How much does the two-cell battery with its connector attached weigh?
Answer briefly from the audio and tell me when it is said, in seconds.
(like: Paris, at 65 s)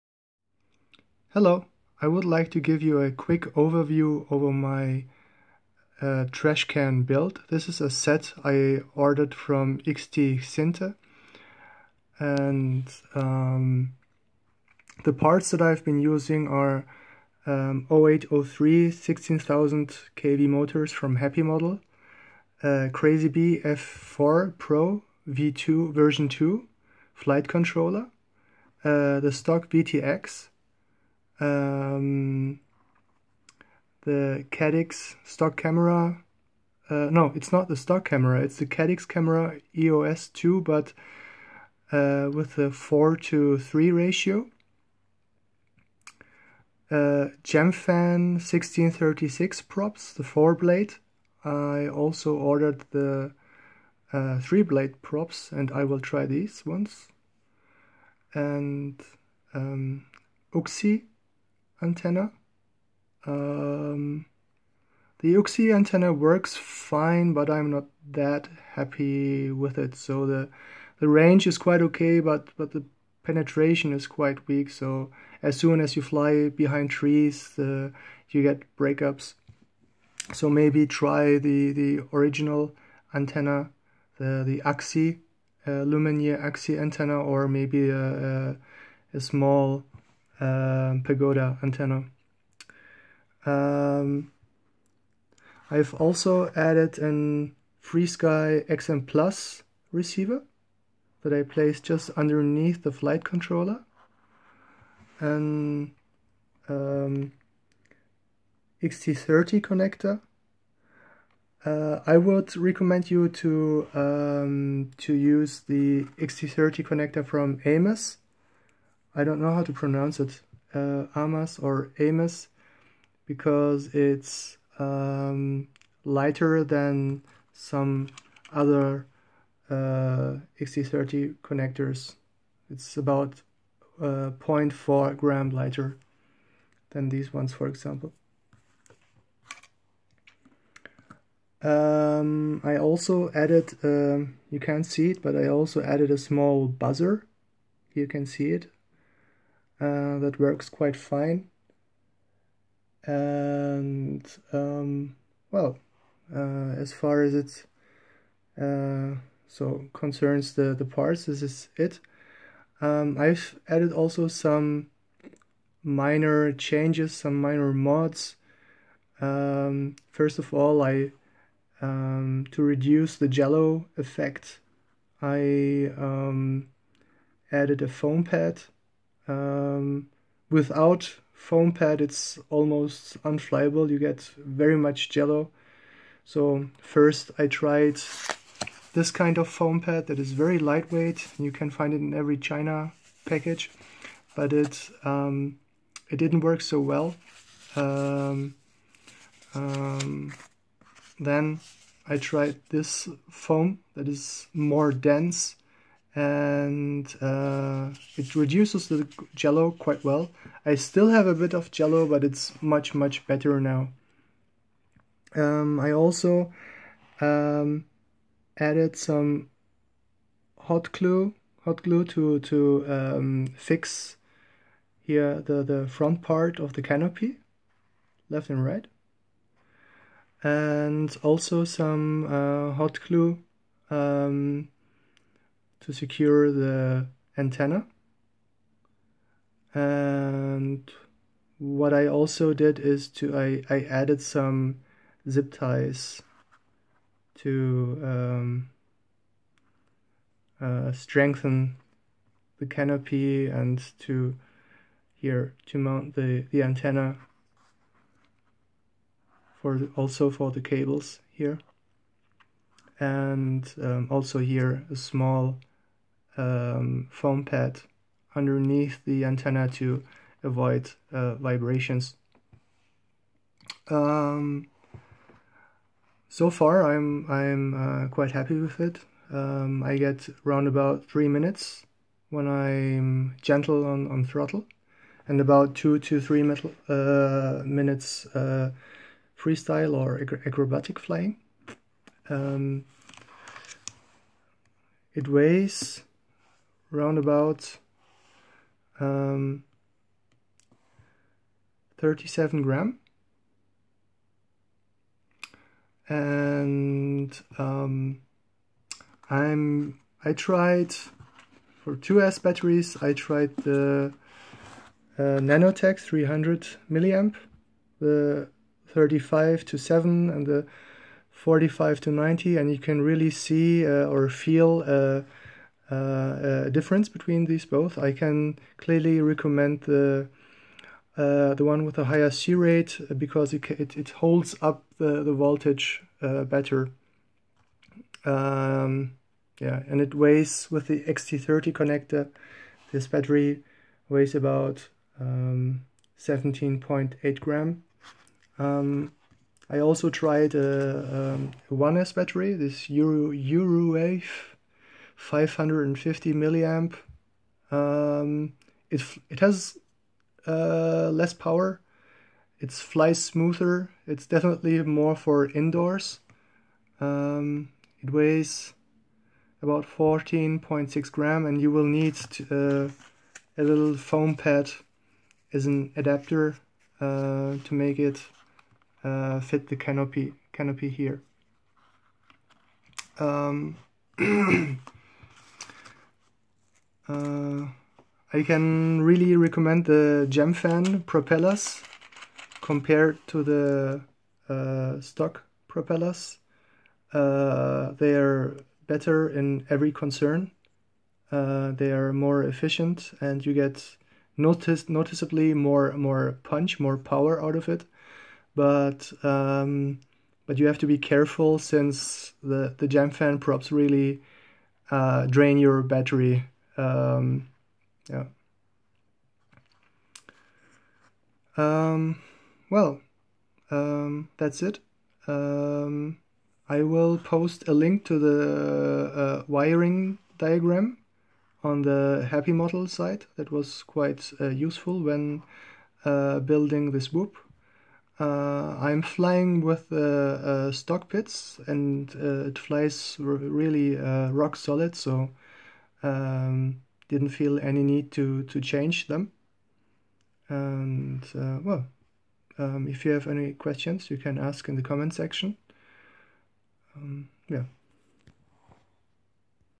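17.8 grams, at 345 s.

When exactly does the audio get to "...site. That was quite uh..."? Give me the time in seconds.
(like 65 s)
432 s.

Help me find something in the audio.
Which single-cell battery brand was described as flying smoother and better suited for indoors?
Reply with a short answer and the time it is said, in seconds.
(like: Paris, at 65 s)
Eurowave, at 353 s.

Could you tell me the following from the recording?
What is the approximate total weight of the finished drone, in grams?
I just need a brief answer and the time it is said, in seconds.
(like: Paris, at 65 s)
37 grams, at 301 s.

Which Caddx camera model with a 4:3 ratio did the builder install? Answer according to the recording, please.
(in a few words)
EOS 2.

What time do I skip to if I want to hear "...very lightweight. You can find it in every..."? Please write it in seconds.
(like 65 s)
190 s.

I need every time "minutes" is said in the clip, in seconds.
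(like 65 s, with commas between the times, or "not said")
281 s, 287 s.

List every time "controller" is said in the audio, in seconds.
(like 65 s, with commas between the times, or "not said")
27 s, 103 s.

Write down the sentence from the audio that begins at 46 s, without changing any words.
Uh, Gemfan 1636 props, the 4 blade.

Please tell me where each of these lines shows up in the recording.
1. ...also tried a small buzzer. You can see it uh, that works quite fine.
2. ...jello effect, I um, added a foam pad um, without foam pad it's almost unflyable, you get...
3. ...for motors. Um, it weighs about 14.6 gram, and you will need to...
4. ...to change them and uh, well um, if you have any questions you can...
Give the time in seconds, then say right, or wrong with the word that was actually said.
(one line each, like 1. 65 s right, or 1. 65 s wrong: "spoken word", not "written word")
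1. 145 s wrong: "added", not "tried"
2. 173 s right
3. 365 s wrong: "indoors", not "motors"
4. 448 s right.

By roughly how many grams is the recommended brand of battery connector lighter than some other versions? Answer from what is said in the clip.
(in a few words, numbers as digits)
0.4 grams.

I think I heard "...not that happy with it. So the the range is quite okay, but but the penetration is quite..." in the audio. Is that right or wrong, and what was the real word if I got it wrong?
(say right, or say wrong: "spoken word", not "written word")
right.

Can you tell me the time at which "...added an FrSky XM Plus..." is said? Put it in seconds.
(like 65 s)
96 s.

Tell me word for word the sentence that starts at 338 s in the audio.
Um, yeah, and it weighs with the XT30 connector.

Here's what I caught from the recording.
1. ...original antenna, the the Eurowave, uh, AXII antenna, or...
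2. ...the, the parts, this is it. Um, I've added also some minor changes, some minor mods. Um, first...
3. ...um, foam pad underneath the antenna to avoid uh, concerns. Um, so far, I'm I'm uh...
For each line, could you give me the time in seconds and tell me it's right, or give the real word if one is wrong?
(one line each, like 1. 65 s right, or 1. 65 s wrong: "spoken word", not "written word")
1. 82 s wrong: "AXII", not "Eurowave"
2. 160 s right
3. 266 s wrong: "vibrations", not "concerns".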